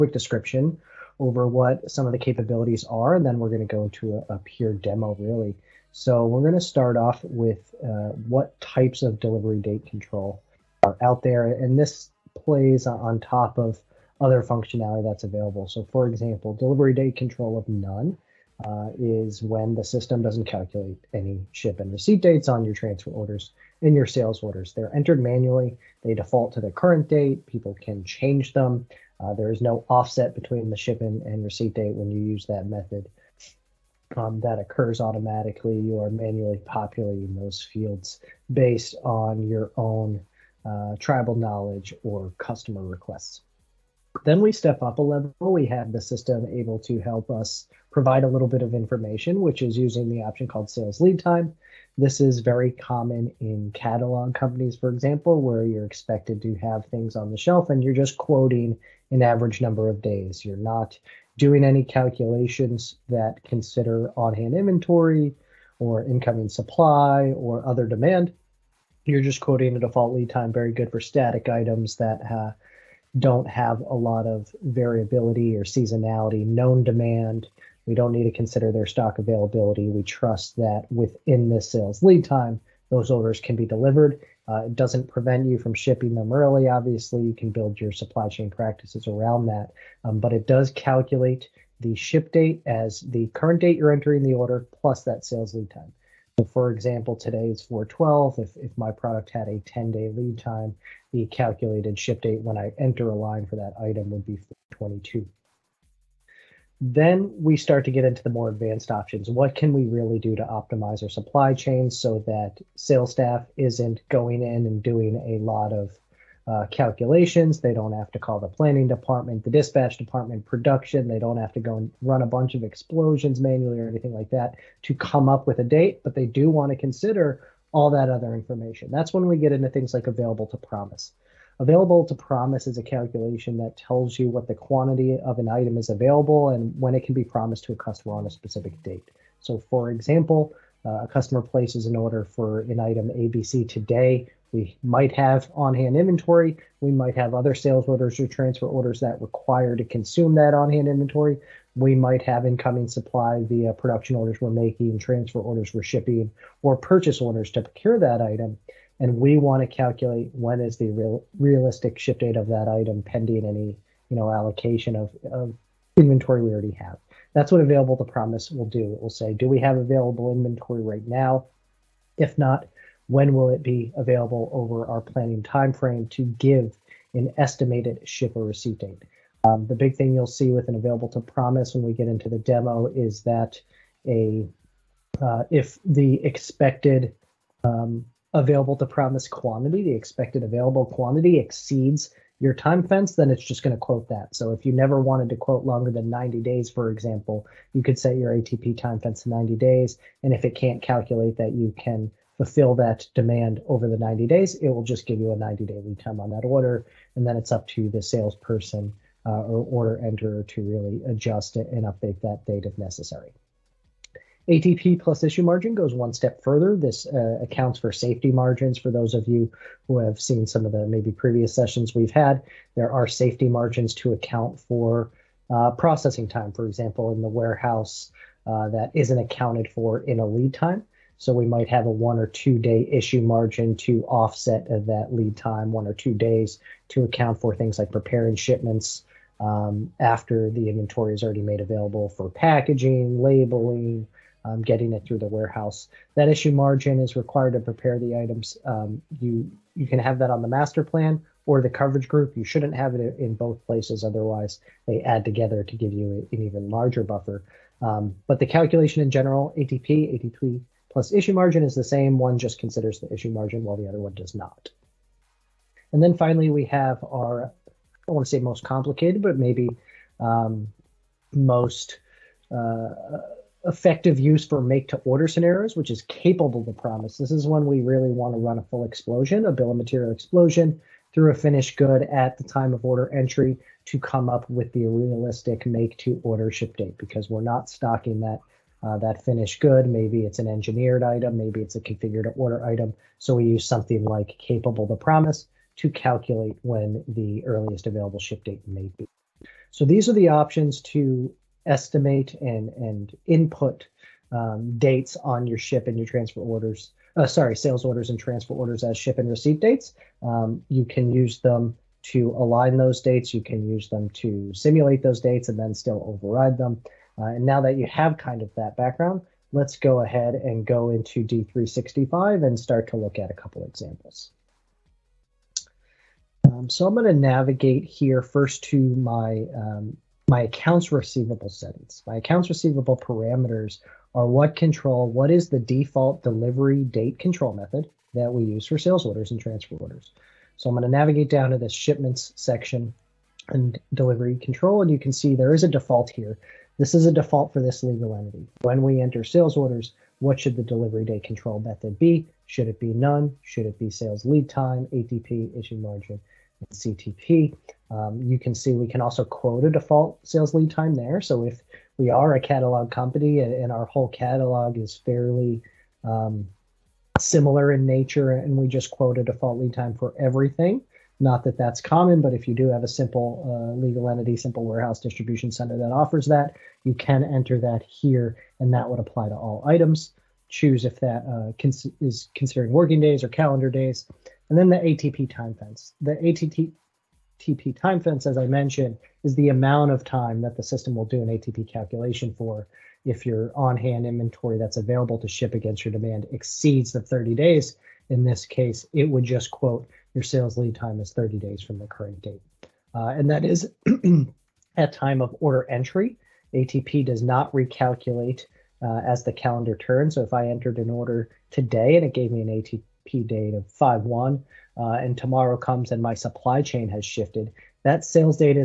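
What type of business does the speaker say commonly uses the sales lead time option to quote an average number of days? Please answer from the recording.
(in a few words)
Catalog companies.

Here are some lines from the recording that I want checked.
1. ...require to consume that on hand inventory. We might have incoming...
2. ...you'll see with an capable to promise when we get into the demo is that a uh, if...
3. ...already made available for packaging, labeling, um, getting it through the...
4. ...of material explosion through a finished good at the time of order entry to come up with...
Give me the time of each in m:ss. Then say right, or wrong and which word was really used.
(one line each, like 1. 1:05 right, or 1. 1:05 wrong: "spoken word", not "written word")
1. 2:29 right
2. 3:00 wrong: "available", not "capable"
3. 4:01 right
4. 4:39 right.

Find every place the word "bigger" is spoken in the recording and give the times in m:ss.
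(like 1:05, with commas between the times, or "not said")
not said.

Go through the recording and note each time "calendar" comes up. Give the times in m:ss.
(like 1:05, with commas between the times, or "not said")
6:23, 6:49.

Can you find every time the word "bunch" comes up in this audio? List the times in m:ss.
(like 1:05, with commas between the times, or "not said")
2:02.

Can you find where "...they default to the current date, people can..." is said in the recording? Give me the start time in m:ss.
0:26.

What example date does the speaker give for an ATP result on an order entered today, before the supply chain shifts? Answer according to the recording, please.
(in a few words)
5/1.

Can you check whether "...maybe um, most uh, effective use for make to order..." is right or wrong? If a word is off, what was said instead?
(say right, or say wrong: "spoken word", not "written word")
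right.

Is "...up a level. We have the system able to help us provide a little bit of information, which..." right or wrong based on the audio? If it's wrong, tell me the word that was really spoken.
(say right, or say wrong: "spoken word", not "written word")
right.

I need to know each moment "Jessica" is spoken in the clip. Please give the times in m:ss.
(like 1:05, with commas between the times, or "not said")
not said.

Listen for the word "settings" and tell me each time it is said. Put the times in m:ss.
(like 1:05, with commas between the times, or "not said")
5:31.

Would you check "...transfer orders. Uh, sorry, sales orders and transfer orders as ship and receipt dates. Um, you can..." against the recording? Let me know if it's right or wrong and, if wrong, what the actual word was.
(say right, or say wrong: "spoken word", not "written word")
right.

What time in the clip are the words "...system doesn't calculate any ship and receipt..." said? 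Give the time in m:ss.
0:19.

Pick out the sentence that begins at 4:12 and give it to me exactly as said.
You shouldn't have it in both places, otherwise they add together to give you an even larger buffer.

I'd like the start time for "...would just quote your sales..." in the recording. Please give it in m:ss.
6:39.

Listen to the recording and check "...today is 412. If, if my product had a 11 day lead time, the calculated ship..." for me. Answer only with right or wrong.
wrong.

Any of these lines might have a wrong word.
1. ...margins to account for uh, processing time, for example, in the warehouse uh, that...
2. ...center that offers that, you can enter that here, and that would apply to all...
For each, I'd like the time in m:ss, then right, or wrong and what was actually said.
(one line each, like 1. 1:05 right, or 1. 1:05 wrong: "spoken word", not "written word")
1. 3:43 right
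2. 6:15 right.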